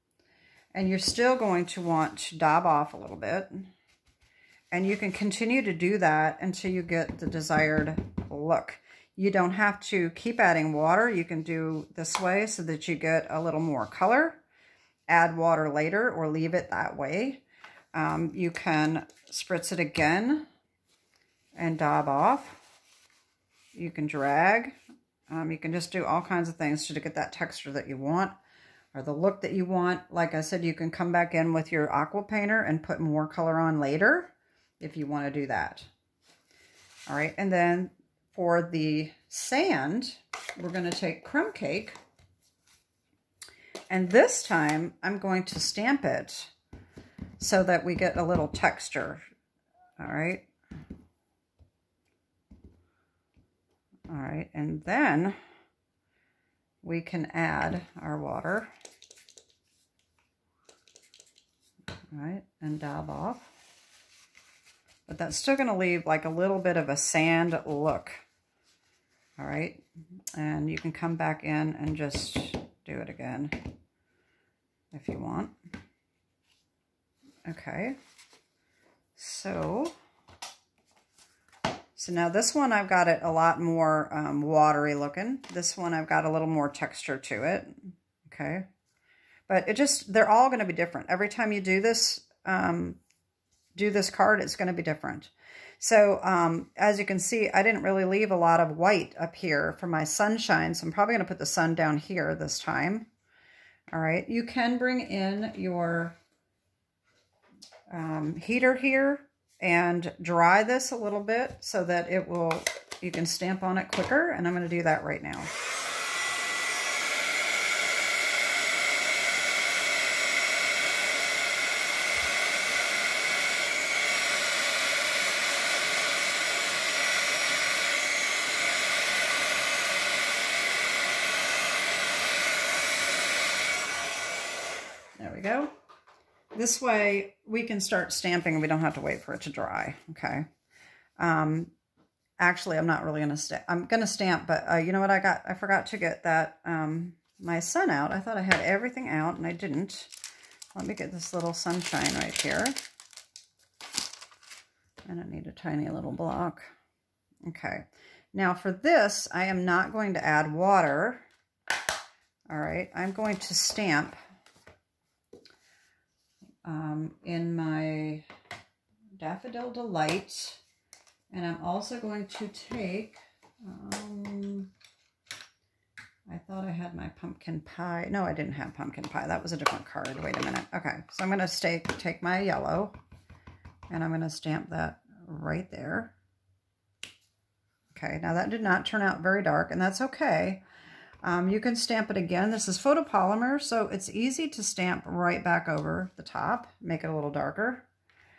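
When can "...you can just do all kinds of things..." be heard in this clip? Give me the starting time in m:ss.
0:25.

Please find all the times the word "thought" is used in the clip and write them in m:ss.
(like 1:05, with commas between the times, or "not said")
2:28, 2:56.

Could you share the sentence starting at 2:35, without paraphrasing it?
And I need a tiny little block.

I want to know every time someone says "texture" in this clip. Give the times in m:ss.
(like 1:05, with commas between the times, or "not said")
0:27, 0:48, 1:26.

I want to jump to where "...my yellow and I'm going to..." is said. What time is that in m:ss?
3:02.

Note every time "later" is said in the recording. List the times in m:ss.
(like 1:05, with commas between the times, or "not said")
0:15, 0:33.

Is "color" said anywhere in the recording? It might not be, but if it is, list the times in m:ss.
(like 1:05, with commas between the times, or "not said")
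0:13, 0:33.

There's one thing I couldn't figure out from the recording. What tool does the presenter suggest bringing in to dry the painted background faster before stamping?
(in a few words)
heater.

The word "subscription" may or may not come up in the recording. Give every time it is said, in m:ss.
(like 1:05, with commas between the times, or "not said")
not said.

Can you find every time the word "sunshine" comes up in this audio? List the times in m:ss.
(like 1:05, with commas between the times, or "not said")
1:40, 2:31.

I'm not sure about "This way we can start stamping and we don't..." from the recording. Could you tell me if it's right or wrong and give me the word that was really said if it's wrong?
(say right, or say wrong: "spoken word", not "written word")
right.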